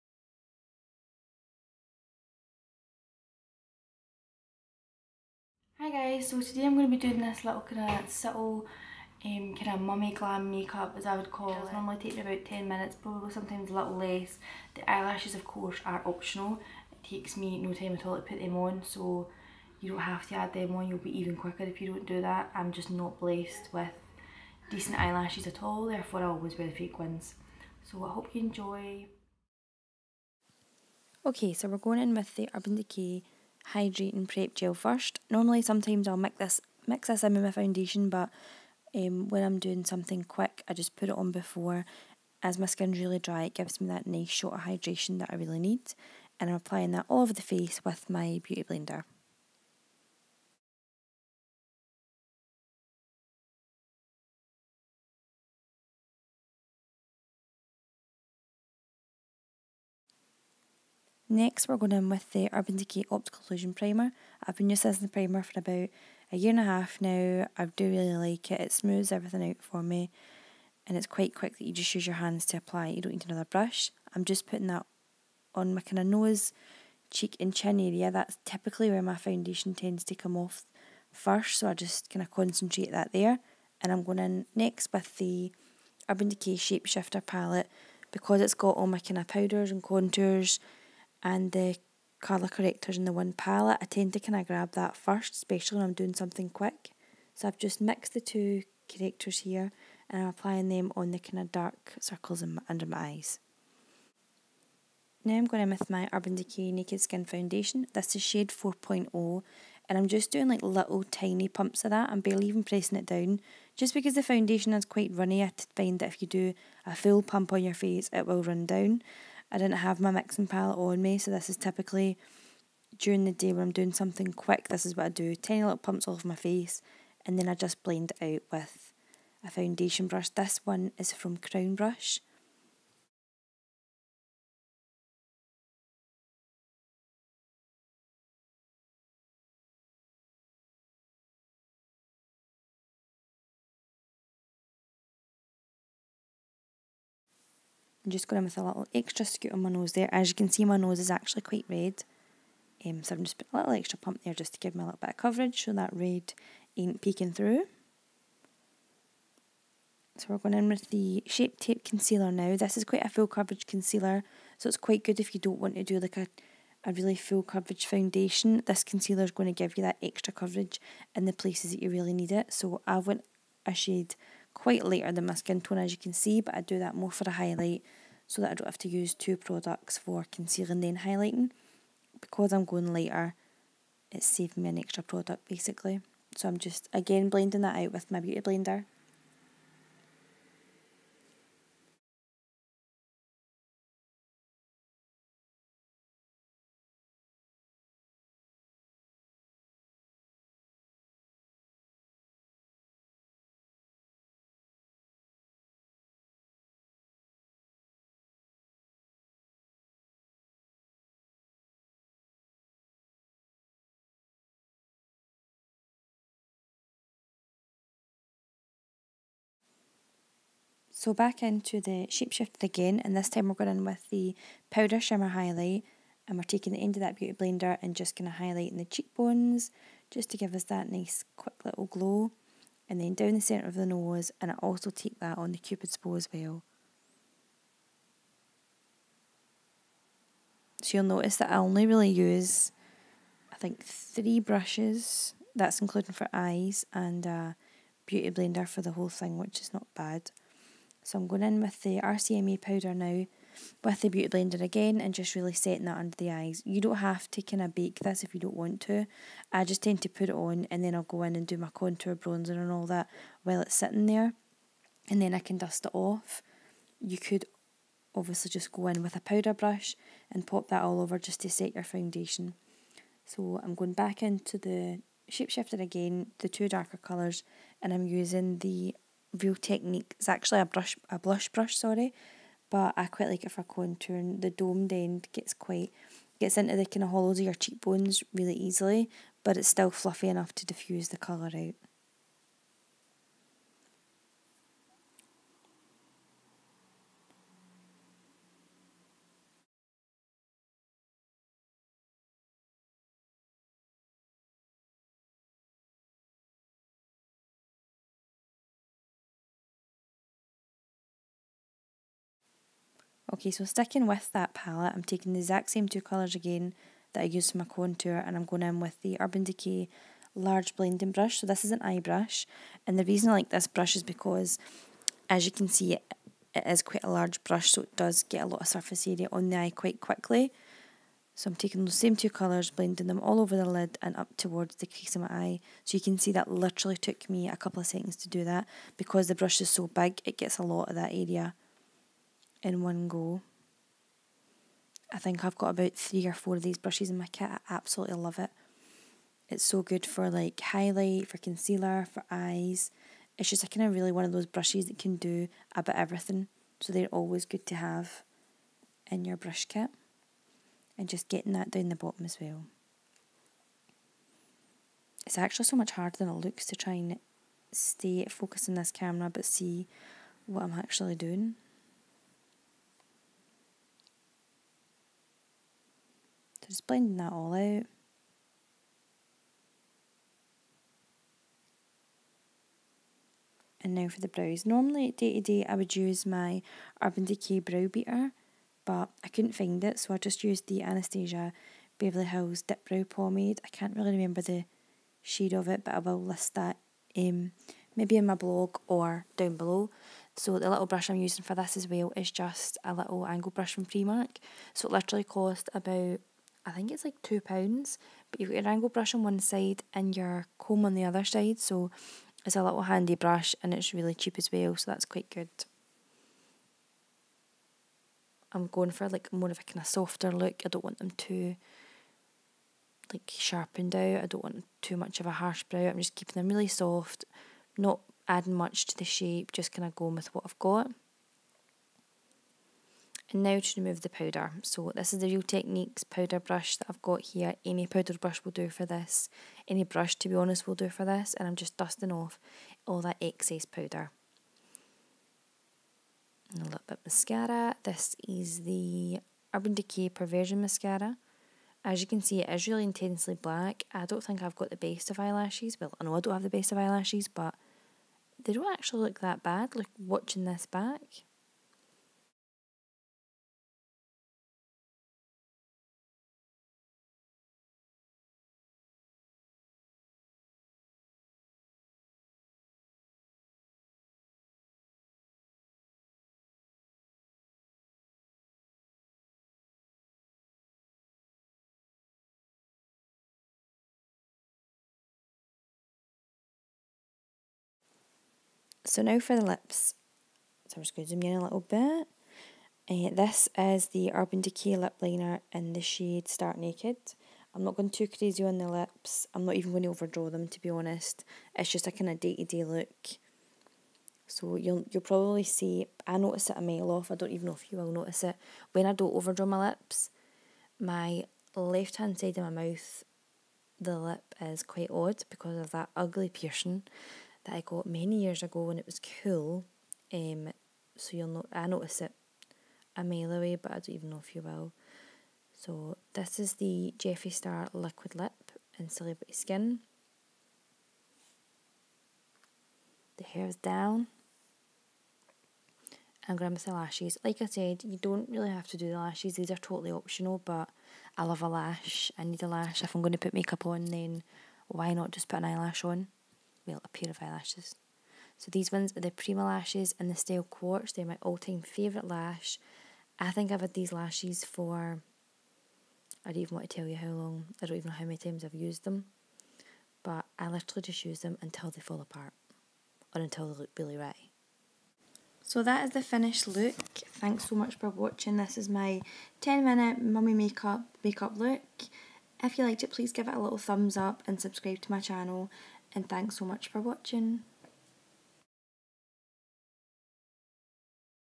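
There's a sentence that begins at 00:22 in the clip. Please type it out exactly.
I'm just not blessed with decent eyelashes at all, therefore I always wear the fake ones.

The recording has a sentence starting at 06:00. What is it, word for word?
And just getting that down the bottom as well.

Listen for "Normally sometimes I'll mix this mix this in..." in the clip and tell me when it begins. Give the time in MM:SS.
00:35.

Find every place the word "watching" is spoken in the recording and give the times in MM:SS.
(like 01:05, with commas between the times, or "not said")
07:39, 09:27, 09:36.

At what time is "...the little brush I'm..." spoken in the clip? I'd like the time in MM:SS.
06:40.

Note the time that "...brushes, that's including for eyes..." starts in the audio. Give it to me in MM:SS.
04:04.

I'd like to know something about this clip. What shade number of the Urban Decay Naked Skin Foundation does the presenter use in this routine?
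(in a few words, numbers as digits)
4.0.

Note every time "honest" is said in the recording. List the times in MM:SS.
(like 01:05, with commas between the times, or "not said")
07:20, 08:20.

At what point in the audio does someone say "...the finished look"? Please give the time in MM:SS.
09:25.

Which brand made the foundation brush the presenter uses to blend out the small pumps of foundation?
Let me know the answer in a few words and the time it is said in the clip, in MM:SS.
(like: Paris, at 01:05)
Crown Brush, at 02:11.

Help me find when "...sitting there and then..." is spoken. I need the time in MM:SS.
04:23.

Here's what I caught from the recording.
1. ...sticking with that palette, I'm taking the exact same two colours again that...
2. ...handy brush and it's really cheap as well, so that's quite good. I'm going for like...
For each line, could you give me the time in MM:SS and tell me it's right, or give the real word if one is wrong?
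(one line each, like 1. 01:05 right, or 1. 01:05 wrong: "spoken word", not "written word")
1. 05:13 right
2. 06:52 right.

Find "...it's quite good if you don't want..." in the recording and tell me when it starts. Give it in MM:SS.
02:44.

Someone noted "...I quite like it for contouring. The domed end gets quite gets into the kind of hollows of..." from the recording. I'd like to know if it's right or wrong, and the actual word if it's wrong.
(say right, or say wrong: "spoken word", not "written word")
right.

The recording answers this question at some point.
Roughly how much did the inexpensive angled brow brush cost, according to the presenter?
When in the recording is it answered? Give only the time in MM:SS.
06:47.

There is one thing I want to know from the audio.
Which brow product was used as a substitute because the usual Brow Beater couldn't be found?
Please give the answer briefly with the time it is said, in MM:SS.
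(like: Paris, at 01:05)
Dip Brow Pomade, at 06:32.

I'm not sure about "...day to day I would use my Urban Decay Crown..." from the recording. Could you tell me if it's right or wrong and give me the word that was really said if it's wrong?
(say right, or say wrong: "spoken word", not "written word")
wrong: "Brow", not "Crown".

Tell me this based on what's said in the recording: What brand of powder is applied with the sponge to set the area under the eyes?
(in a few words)
RCMA.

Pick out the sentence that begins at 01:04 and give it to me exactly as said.
I've been using this the primer for about a year and a half now.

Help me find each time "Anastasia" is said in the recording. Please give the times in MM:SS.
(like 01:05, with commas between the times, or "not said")
06:30.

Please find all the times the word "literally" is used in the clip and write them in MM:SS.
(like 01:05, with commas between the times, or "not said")
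05:36, 06:44, 09:20.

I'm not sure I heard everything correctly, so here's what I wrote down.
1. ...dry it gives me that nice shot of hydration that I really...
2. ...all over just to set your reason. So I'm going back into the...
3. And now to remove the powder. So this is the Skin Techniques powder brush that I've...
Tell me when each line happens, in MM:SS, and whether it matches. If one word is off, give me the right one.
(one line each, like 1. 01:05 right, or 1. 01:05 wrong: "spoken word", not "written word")
1. 00:43 right
2. 04:30 wrong: "foundation", not "reason"
3. 07:13 wrong: "Real", not "Skin".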